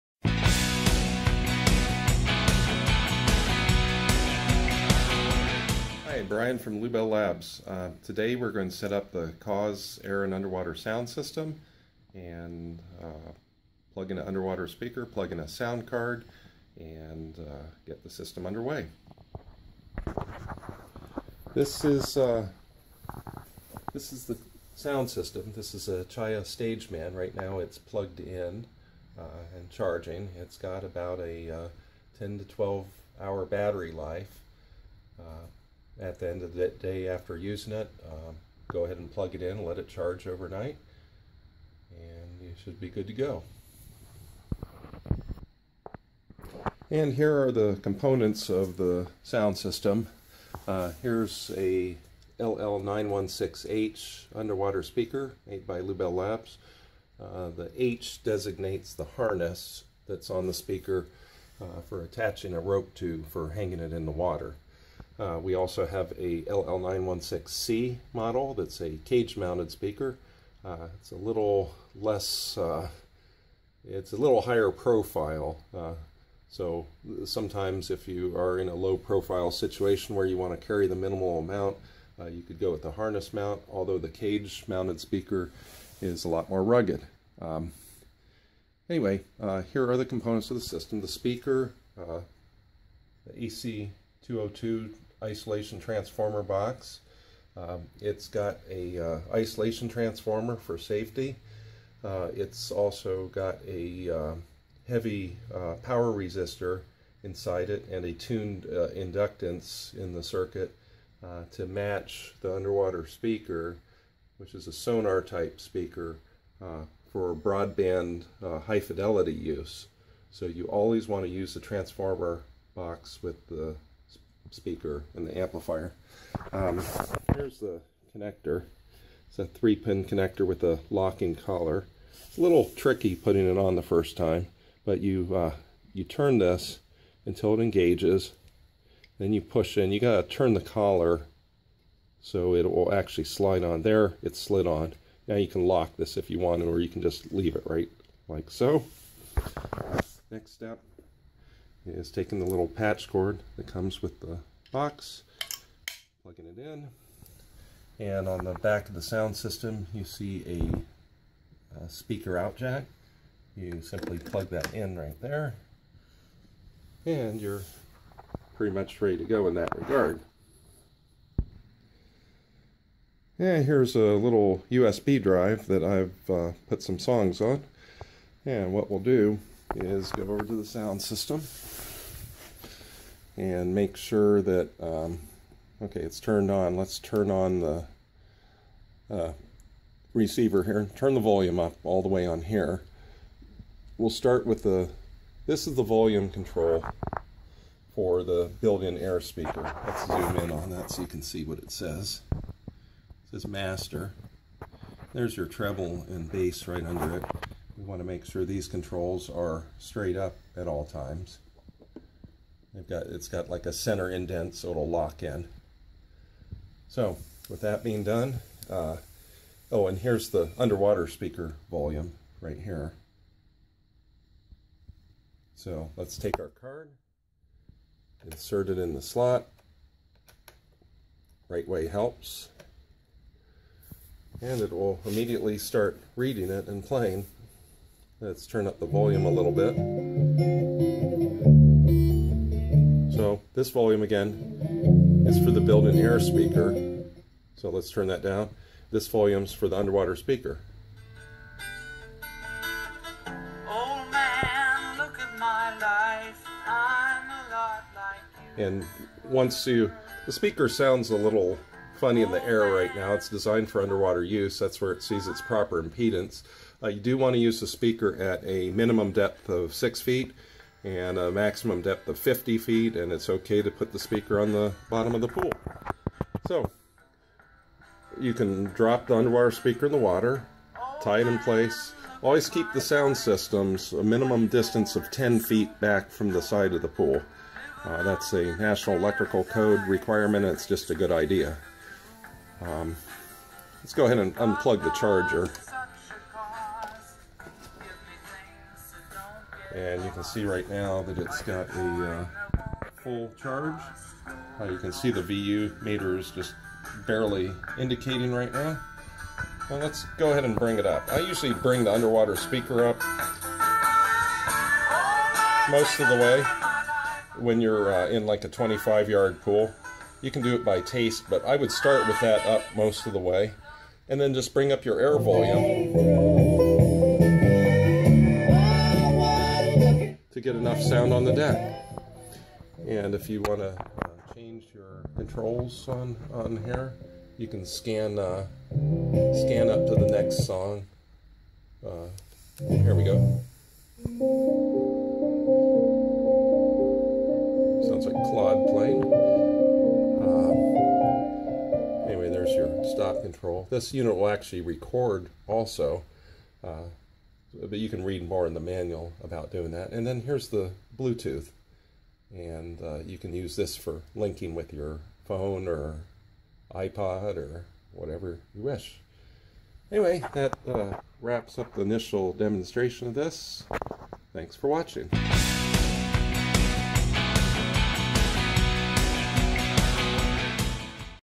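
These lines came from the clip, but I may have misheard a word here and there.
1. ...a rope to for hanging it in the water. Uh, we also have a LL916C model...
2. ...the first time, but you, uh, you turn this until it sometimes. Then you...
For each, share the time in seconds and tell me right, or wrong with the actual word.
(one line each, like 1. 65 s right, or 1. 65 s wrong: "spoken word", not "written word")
1. 62 s right
2. 133 s wrong: "engages", not "sometimes".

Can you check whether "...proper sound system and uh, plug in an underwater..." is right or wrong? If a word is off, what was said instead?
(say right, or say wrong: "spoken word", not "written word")
wrong: "underwater", not "proper".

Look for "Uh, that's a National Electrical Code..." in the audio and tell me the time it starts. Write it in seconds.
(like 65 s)
287 s.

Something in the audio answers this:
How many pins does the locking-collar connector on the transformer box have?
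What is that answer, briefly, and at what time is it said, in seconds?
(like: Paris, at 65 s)
3, at 129 s.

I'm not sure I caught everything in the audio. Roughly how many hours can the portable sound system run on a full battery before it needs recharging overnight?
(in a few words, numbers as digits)
10 to 12 hours.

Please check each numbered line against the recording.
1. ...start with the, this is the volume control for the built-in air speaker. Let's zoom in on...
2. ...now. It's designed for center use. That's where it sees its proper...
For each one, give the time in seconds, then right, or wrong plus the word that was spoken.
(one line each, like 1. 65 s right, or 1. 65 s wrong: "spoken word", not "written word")
1. 194 s right
2. 262 s wrong: "underwater", not "center".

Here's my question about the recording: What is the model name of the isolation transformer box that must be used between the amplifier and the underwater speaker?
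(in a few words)
EC 202.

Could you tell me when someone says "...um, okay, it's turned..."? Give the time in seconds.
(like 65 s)
184 s.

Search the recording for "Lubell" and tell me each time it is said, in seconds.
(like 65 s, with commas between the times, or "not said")
6 s, 55 s.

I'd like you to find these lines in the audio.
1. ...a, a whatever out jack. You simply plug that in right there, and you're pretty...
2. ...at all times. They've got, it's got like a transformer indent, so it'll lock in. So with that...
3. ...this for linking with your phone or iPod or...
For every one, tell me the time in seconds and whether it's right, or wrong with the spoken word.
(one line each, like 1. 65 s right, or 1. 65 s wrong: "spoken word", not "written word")
1. 160 s wrong: "speaker", not "whatever"
2. 210 s wrong: "center", not "transformer"
3. 363 s right.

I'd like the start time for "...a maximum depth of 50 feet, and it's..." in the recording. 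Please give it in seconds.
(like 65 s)
271 s.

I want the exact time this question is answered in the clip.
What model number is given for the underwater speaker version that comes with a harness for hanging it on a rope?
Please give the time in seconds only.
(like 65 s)
52 s.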